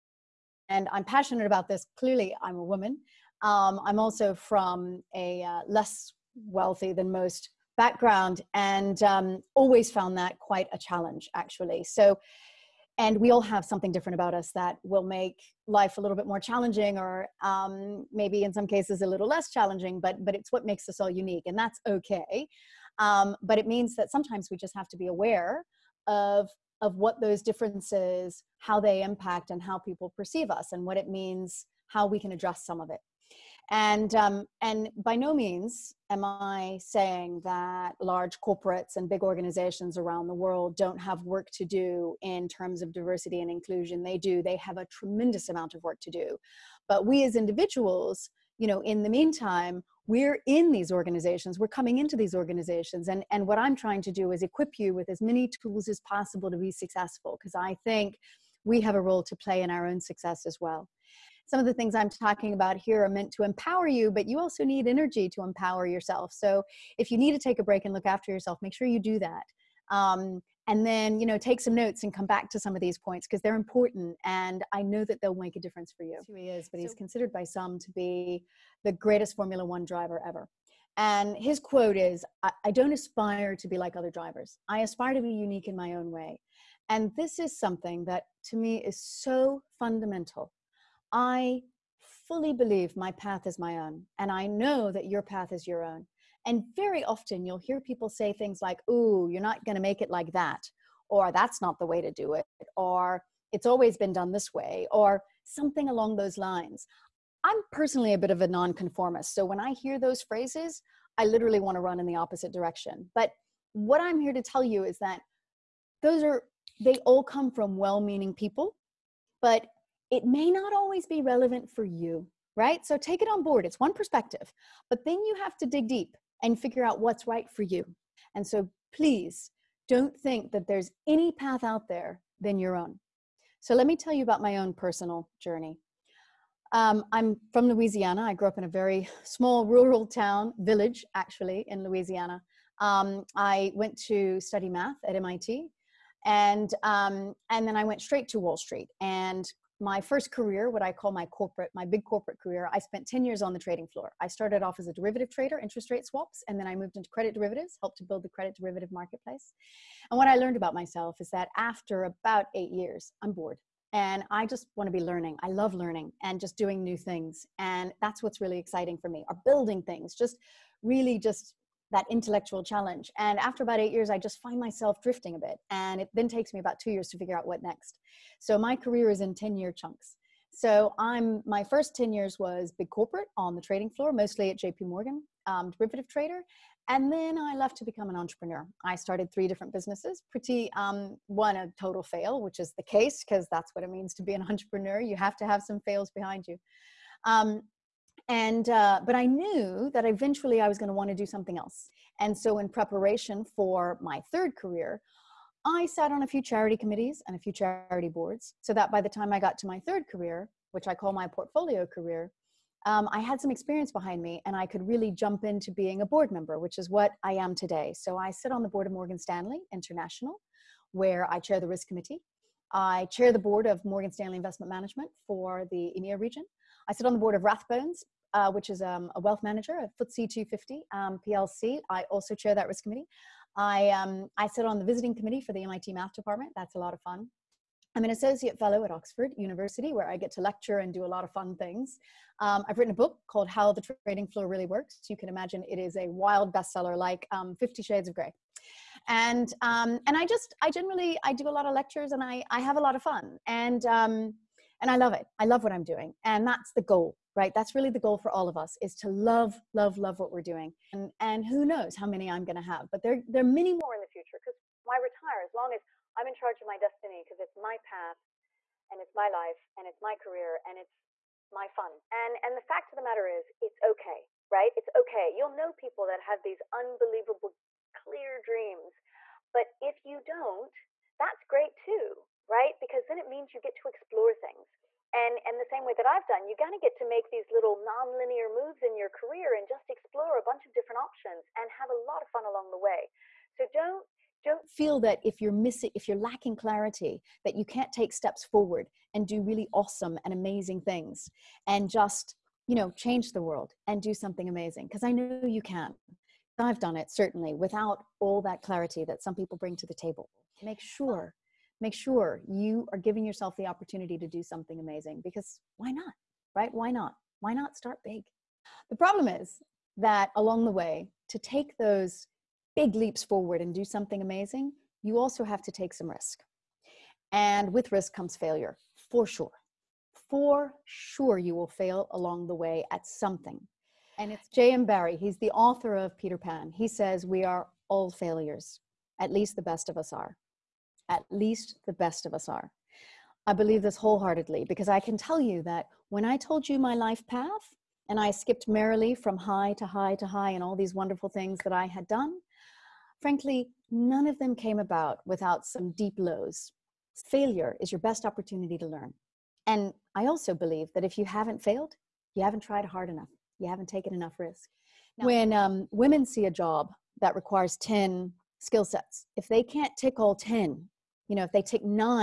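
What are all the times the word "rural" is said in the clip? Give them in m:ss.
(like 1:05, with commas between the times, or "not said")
2:19.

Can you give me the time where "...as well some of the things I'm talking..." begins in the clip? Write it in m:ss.
1:00.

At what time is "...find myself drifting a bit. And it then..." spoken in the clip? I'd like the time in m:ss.
2:54.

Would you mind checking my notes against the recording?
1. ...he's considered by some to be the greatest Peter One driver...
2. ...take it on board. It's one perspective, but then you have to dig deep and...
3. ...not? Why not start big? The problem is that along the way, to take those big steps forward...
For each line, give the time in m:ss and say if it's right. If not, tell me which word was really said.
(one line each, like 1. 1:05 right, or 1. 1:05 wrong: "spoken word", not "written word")
1. 1:16 wrong: "Formula", not "Peter"
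2. 2:02 right
3. 5:16 wrong: "leaps", not "steps".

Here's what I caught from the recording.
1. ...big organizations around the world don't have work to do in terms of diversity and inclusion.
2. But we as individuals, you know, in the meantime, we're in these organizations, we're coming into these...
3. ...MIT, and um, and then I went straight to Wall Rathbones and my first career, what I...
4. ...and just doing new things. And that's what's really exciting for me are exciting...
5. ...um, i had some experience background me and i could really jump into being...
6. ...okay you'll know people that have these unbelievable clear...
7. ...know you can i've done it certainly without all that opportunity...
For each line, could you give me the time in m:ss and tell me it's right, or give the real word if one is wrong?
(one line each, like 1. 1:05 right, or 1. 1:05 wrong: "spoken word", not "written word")
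1. 0:39 right
2. 0:46 right
3. 2:25 wrong: "Street", not "Rathbones"
4. 2:46 wrong: "building", not "exciting"
5. 3:32 wrong: "behind", not "background"
6. 4:35 right
7. 5:05 wrong: "clarity", not "opportunity".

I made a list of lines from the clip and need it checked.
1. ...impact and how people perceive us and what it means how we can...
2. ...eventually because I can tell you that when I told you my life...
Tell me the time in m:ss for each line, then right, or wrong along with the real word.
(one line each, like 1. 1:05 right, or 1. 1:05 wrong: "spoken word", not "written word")
1. 0:29 right
2. 5:43 wrong: "wholeheartedly", not "eventually".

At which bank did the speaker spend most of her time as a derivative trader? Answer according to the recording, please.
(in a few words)
JP Morgan.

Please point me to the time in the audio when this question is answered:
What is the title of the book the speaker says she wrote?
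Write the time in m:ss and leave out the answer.
4:03.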